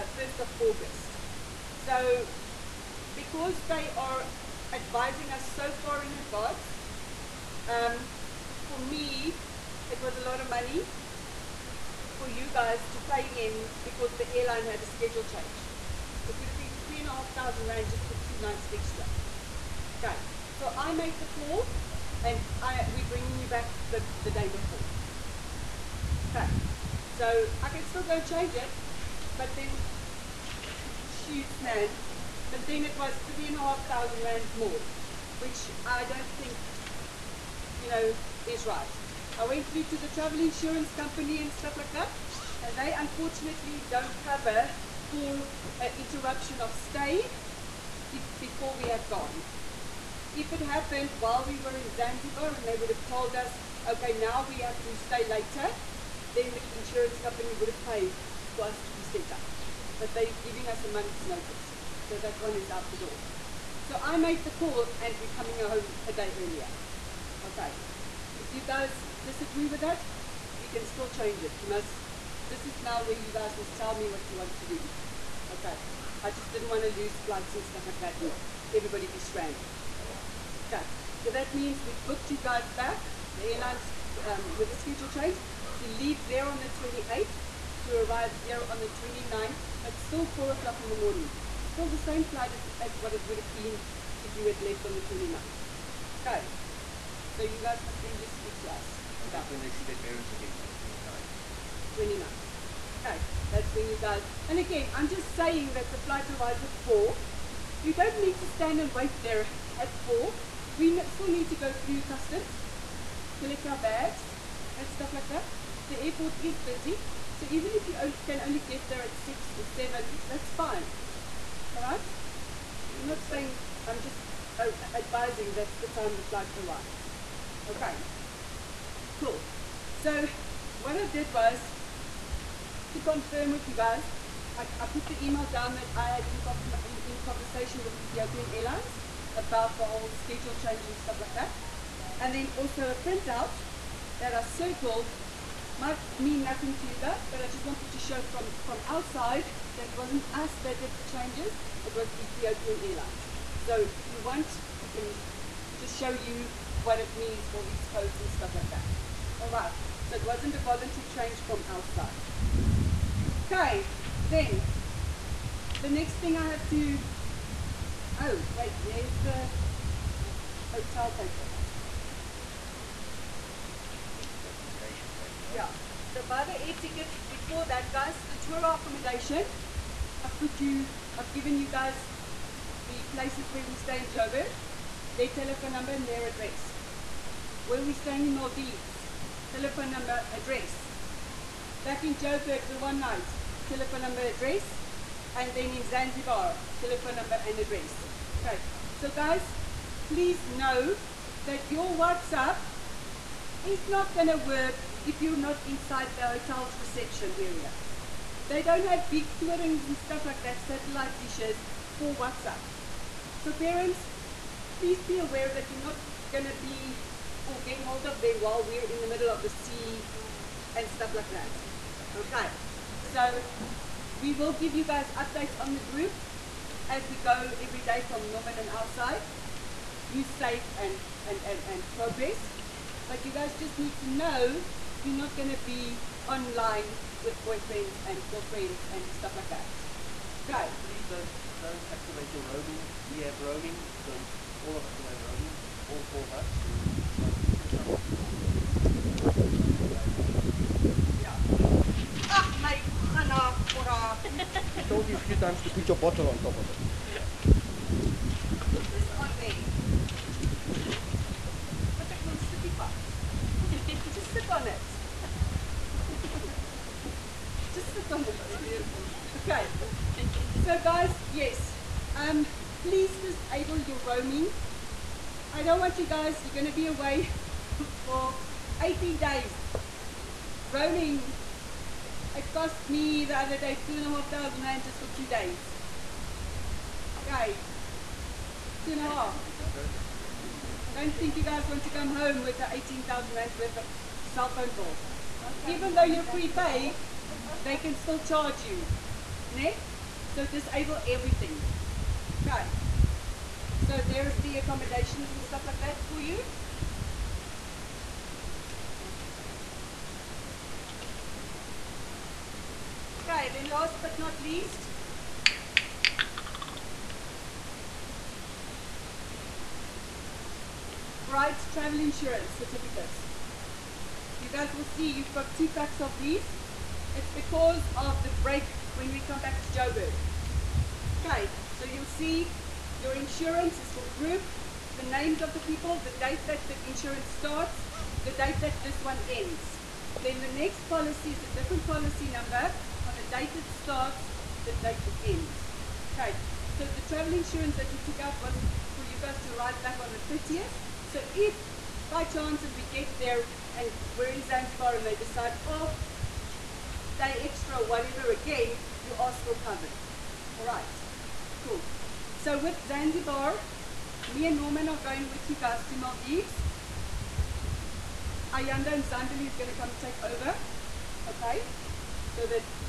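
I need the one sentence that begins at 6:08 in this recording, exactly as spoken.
Ayanda and Zandali is going to come take over, okay?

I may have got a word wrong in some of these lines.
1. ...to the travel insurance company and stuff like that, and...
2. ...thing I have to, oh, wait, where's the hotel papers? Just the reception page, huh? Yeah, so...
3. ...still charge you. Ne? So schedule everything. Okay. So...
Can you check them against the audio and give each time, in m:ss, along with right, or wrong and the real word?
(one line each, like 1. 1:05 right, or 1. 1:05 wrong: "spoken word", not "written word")
1. 0:39 right
2. 2:46 wrong: "documentation", not "reception"
3. 4:57 wrong: "disable", not "schedule".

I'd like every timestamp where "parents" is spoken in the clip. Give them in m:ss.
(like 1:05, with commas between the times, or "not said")
1:39, 3:33.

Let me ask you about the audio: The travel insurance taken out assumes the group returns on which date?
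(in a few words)
30th.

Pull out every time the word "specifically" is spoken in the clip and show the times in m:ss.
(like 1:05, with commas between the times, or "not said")
not said.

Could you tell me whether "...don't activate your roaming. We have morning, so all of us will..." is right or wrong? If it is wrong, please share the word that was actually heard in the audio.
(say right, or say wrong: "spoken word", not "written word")
wrong: "roaming", not "morning".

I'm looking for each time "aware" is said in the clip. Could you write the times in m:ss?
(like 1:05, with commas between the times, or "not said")
3:35.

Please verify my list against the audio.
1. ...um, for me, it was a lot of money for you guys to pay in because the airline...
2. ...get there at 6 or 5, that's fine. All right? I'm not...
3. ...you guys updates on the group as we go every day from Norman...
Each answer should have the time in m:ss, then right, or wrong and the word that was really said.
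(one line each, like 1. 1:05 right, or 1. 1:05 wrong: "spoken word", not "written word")
1. 0:07 right
2. 1:58 wrong: "7", not "5"
3. 3:44 right.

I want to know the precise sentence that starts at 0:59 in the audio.
But they're giving us a month's notice.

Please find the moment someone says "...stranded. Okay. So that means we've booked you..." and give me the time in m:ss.
1:19.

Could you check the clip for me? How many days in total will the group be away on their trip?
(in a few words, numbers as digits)
18 days.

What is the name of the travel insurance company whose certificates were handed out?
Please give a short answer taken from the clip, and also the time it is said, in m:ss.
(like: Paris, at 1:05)
Bright Travel Insurance, at 5:21.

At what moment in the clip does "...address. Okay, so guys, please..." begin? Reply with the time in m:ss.
3:17.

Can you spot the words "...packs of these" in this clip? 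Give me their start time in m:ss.
5:25.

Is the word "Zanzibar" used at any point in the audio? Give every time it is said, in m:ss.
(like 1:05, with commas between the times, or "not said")
0:51, 3:15, 5:54, 6:02.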